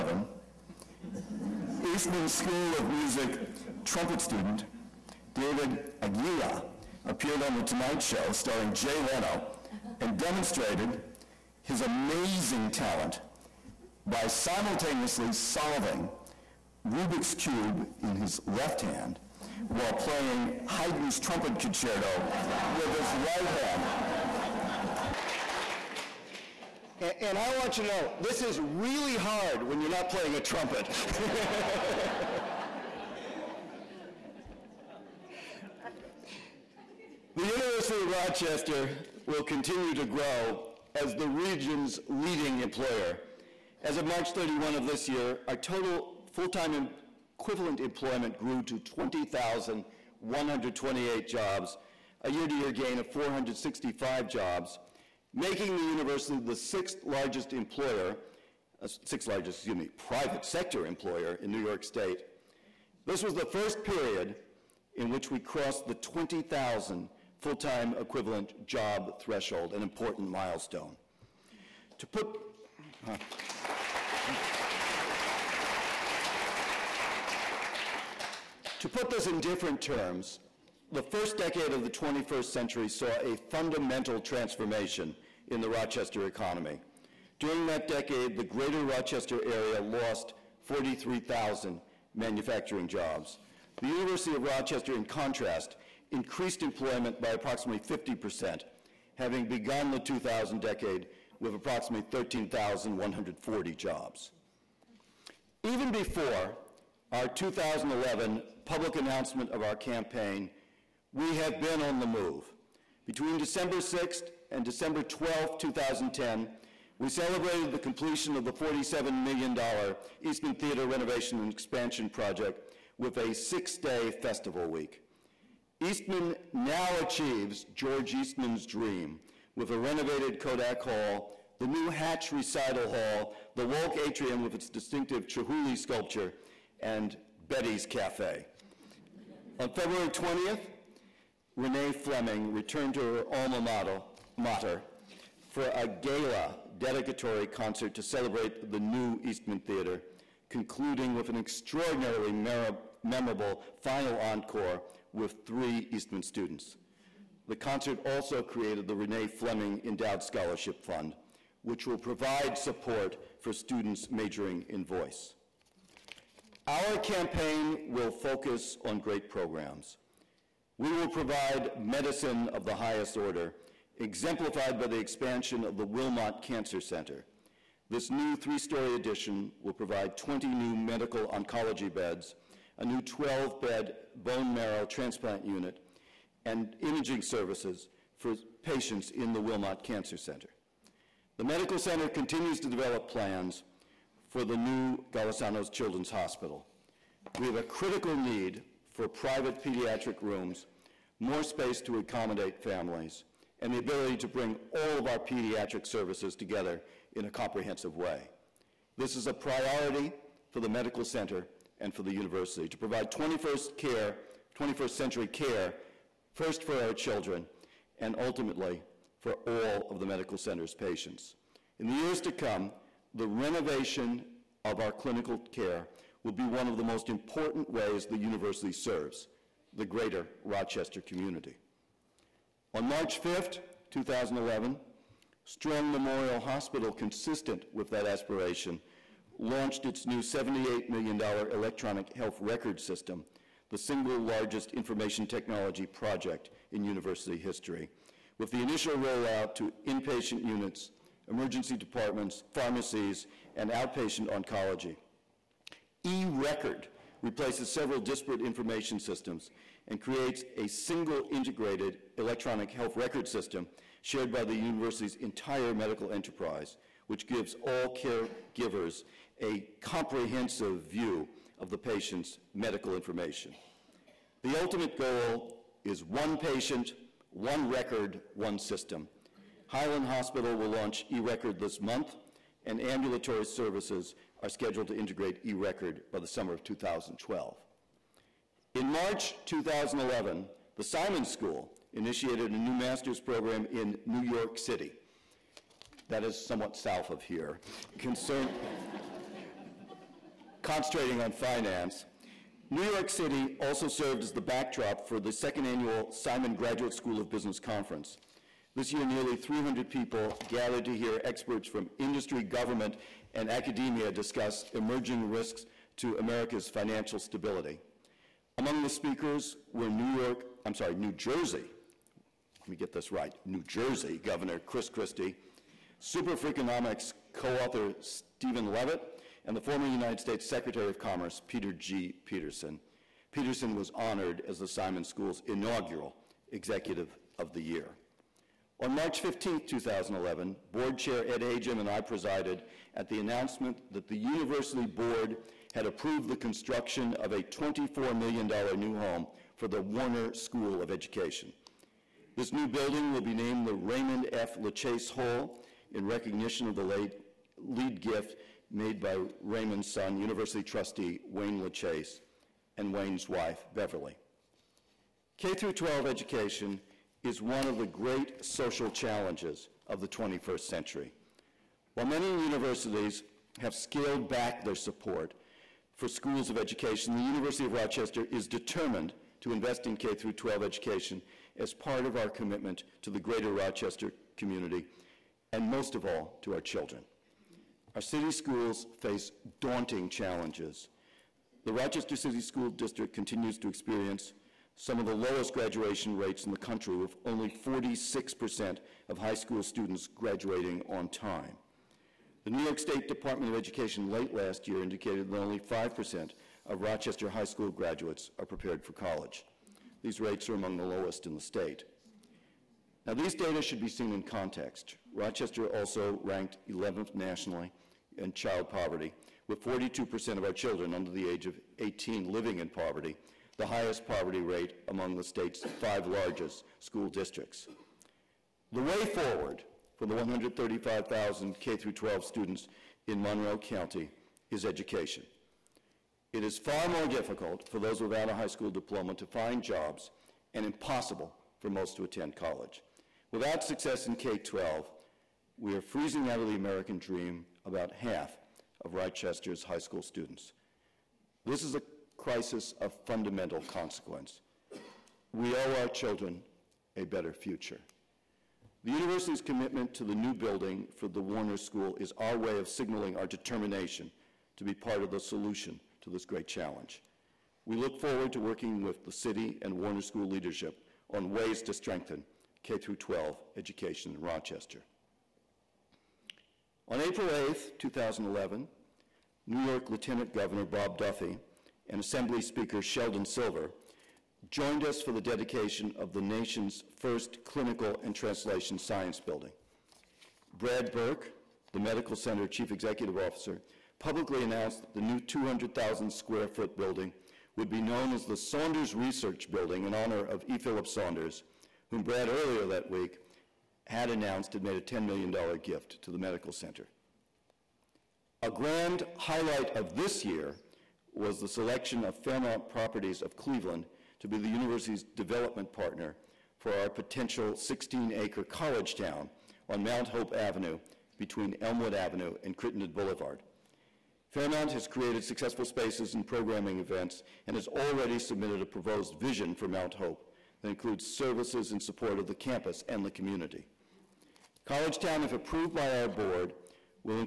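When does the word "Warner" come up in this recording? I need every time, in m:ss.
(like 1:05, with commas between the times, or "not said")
5:49, 7:41, 7:49.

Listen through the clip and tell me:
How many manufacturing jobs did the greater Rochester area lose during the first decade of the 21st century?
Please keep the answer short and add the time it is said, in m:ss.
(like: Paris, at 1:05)
43,000, at 1:30.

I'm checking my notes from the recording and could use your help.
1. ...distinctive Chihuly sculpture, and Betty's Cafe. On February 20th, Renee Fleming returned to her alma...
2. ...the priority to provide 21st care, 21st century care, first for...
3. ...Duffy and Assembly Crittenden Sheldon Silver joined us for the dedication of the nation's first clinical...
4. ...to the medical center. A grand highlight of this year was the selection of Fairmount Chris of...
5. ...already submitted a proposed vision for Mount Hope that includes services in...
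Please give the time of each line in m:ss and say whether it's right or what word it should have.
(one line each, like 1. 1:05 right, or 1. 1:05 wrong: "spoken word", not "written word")
1. 2:14 right
2. 3:32 wrong: "university", not "priority"
3. 8:00 wrong: "Speaker", not "Crittenden"
4. 8:26 wrong: "Properties", not "Chris"
5. 8:47 right.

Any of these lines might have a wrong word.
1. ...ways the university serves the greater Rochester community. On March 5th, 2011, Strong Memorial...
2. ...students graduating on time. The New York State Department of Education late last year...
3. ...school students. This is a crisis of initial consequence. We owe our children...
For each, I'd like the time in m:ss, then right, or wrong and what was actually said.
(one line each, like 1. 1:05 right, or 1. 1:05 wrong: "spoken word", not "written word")
1. 3:47 right
2. 6:39 right
3. 7:29 wrong: "fundamental", not "initial".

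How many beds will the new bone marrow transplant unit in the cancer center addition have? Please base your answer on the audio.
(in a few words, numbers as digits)
12.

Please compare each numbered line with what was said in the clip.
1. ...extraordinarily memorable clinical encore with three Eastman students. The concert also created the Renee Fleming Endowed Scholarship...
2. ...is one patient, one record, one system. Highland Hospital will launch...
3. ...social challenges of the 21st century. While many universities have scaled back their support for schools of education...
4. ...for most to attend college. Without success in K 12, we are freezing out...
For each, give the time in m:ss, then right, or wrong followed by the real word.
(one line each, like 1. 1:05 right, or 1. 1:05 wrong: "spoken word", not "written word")
1. 2:31 wrong: "final", not "clinical"
2. 4:35 right
3. 6:08 right
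4. 7:21 right.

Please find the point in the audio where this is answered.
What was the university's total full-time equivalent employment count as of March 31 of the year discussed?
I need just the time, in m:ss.
0:48.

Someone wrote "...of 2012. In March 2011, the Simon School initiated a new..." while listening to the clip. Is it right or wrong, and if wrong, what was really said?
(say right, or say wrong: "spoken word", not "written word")
right.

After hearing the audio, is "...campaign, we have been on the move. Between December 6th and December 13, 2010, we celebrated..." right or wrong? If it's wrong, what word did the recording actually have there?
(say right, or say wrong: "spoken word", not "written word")
wrong: "12", not "13".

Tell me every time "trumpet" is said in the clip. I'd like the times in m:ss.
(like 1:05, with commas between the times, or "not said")
0:03, 0:21, 0:30.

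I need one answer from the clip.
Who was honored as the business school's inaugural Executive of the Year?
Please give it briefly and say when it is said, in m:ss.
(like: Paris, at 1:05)
Peter G. Peterson, at 5:31.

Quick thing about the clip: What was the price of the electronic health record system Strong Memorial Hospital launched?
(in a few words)
$78 million.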